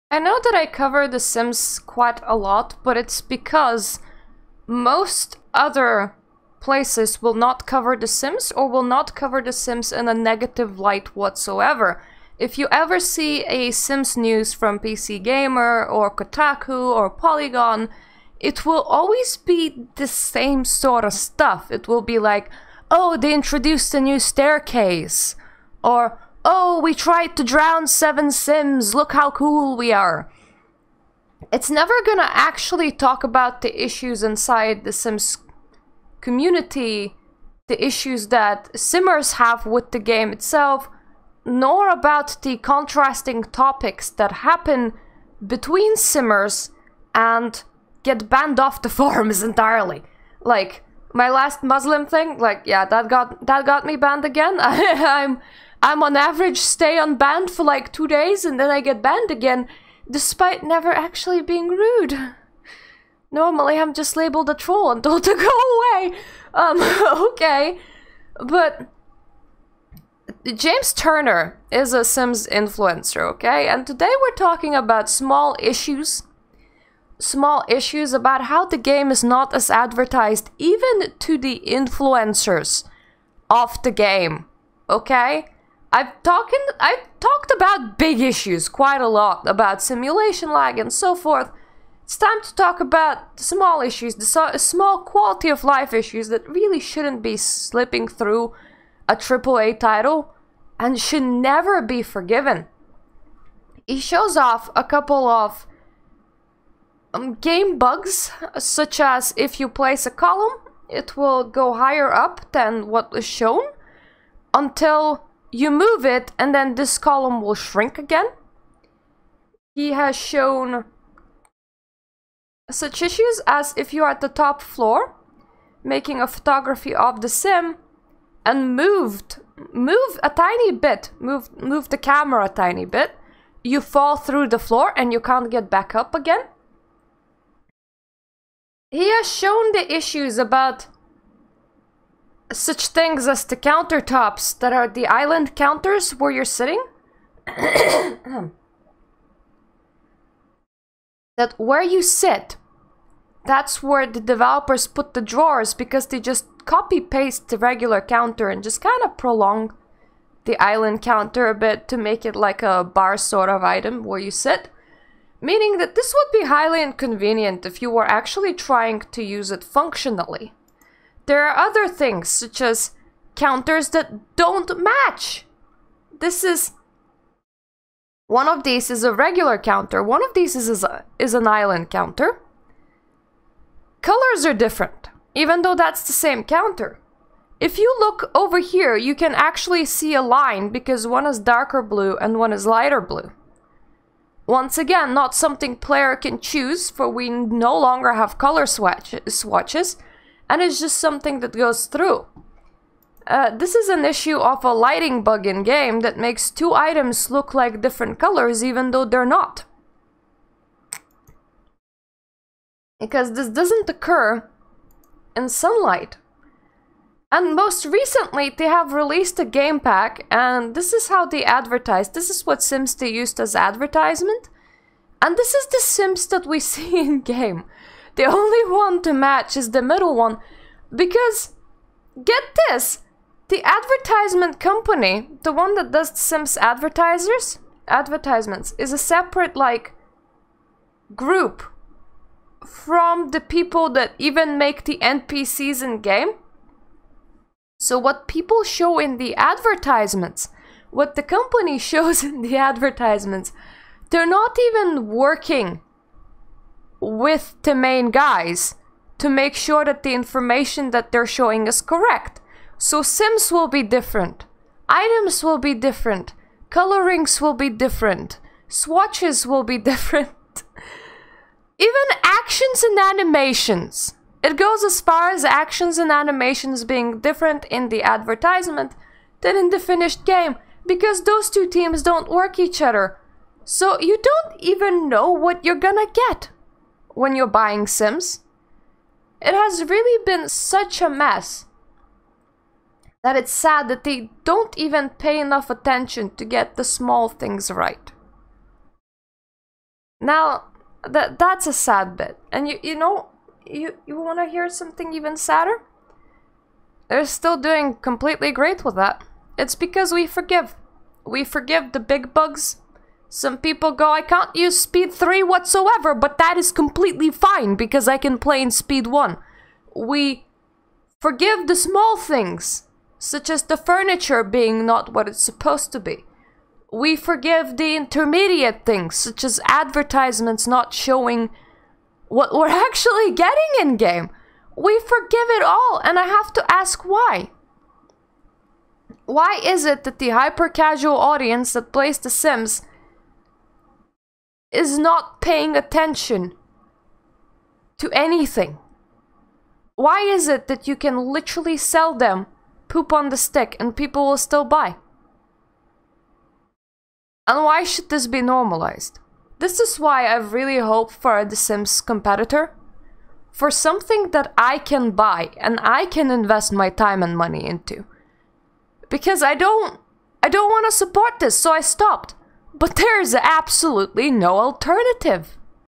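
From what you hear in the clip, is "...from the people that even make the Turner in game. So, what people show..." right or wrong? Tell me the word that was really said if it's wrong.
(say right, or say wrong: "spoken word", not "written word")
wrong: "NPCs", not "Turner".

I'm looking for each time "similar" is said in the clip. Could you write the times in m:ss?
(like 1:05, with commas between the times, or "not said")
not said.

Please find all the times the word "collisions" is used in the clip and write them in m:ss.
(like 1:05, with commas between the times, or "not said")
not said.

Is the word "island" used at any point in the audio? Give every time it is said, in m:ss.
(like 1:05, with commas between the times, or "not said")
2:25, 2:40, 3:01.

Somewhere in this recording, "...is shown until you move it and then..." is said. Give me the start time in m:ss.
1:53.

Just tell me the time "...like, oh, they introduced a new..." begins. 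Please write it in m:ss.
0:22.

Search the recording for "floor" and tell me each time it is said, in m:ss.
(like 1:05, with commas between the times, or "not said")
2:04, 2:14.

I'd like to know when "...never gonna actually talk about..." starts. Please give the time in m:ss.
0:31.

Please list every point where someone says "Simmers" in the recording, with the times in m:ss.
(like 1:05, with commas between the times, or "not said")
0:38, 0:45.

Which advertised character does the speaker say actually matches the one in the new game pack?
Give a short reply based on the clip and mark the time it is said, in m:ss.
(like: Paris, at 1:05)
The middle one, at 3:49.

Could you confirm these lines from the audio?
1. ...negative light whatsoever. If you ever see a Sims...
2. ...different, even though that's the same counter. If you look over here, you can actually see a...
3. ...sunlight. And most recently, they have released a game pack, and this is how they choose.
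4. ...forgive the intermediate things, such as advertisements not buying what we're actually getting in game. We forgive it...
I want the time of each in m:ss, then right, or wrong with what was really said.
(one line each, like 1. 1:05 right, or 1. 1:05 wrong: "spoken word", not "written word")
1. 0:10 right
2. 3:04 right
3. 3:35 wrong: "advertise", not "choose"
4. 5:27 wrong: "showing", not "buying".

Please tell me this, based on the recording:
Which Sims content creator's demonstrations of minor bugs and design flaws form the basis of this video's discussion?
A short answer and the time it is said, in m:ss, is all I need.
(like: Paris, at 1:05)
James Turner, at 1:10.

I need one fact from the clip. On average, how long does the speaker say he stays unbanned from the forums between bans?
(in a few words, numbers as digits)
2 days.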